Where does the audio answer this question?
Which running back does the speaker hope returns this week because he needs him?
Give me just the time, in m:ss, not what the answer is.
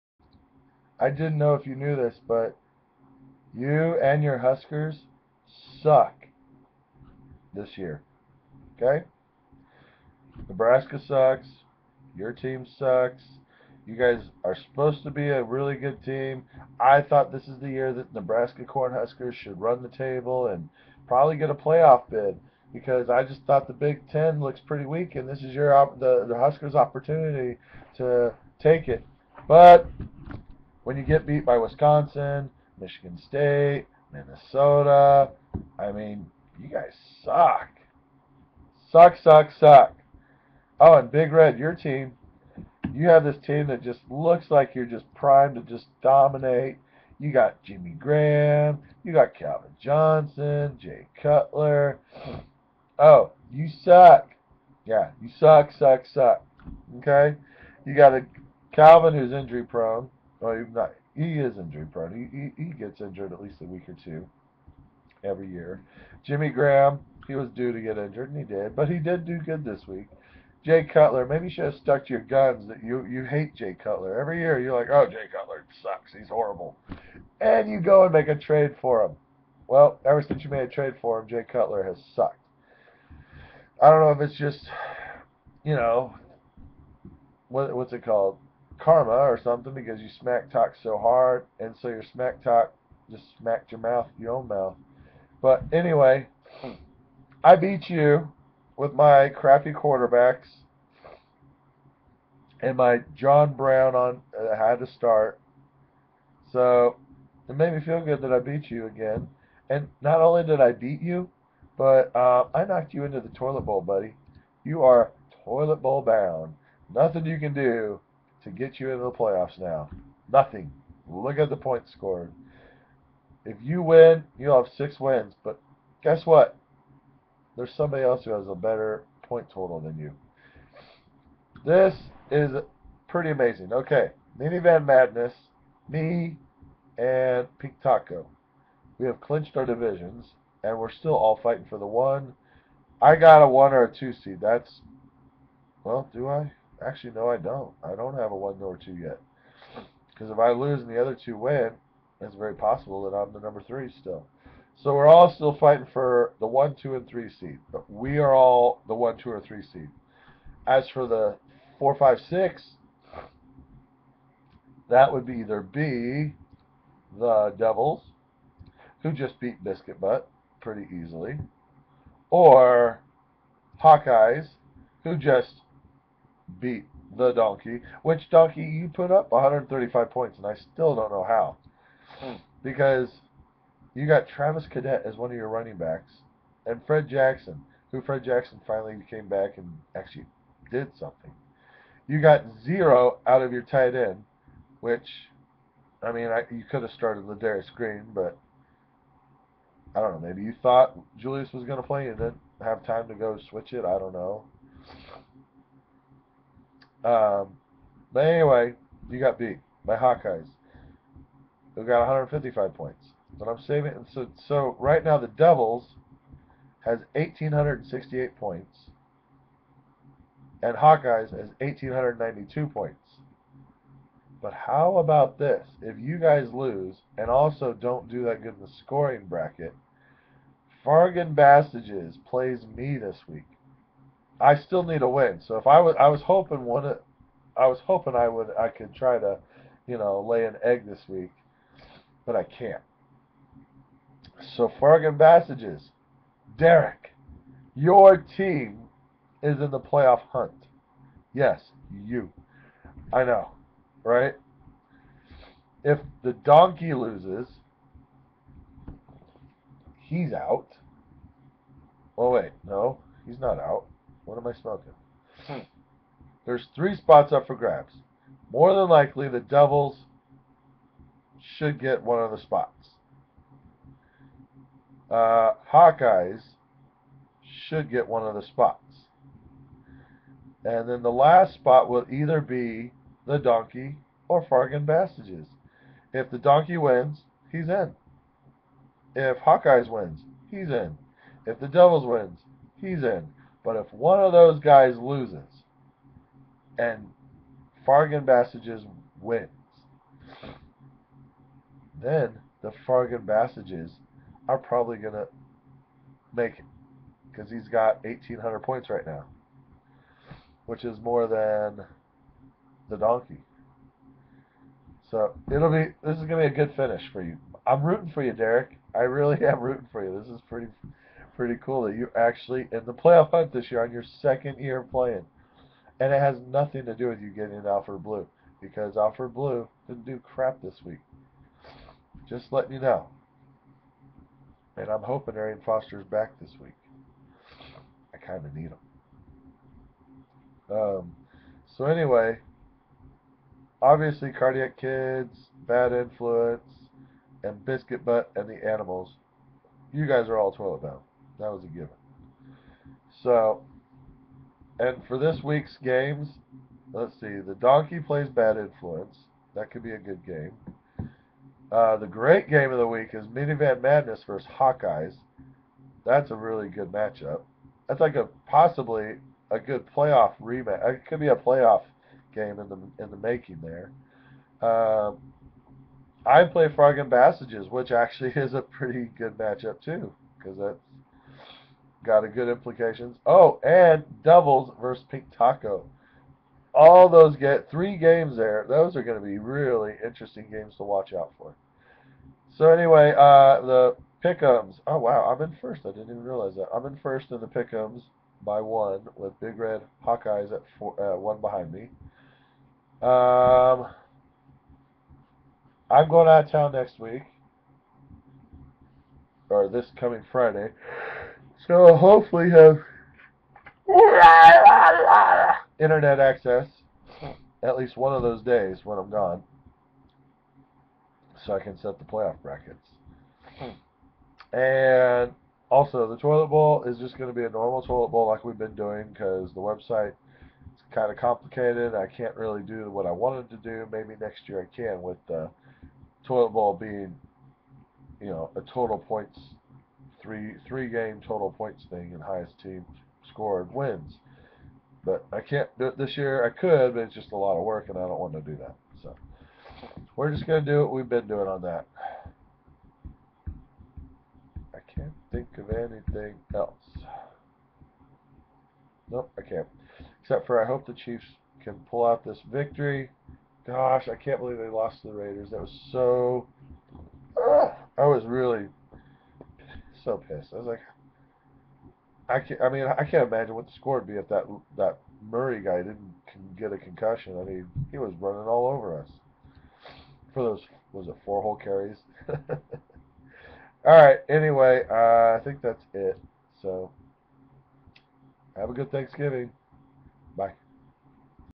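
5:35.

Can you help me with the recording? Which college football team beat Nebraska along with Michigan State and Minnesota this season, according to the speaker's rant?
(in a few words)
Wisconsin.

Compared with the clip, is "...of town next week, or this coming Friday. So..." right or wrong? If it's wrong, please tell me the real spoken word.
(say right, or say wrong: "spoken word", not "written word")
right.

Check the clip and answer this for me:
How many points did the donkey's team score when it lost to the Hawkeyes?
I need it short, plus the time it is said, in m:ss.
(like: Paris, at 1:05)
135, at 2:59.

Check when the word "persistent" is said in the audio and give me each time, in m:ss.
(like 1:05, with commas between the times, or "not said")
not said.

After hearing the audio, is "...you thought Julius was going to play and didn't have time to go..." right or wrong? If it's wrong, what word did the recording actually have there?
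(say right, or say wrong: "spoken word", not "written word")
right.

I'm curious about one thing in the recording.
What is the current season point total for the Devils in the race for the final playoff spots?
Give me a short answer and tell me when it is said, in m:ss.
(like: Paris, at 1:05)
1,868, at 3:37.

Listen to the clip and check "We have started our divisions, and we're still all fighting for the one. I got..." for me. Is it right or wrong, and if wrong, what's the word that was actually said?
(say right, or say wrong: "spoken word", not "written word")
wrong: "clinched", not "started".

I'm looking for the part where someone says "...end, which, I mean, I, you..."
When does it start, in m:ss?
3:13.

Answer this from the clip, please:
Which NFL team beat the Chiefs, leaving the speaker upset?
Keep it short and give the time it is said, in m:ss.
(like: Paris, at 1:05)
Raiders, at 7:45.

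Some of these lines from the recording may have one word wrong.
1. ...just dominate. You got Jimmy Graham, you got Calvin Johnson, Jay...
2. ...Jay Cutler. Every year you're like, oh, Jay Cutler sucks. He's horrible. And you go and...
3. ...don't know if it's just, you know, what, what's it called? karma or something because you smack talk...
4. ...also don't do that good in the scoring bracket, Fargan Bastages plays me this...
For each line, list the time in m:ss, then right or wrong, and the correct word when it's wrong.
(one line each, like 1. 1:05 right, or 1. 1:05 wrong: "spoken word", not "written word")
1. 0:45 right
2. 1:13 right
3. 1:23 right
4. 3:47 right.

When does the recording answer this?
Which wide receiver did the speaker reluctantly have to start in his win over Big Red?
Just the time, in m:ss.
1:43.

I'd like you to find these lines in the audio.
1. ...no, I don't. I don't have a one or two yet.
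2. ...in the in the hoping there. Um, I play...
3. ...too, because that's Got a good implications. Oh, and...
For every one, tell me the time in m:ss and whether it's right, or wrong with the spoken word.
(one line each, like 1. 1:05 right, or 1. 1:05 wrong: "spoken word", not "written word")
1. 2:27 right
2. 6:12 wrong: "making", not "hoping"
3. 6:19 right.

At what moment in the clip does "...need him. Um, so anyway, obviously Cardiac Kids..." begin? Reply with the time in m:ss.
5:38.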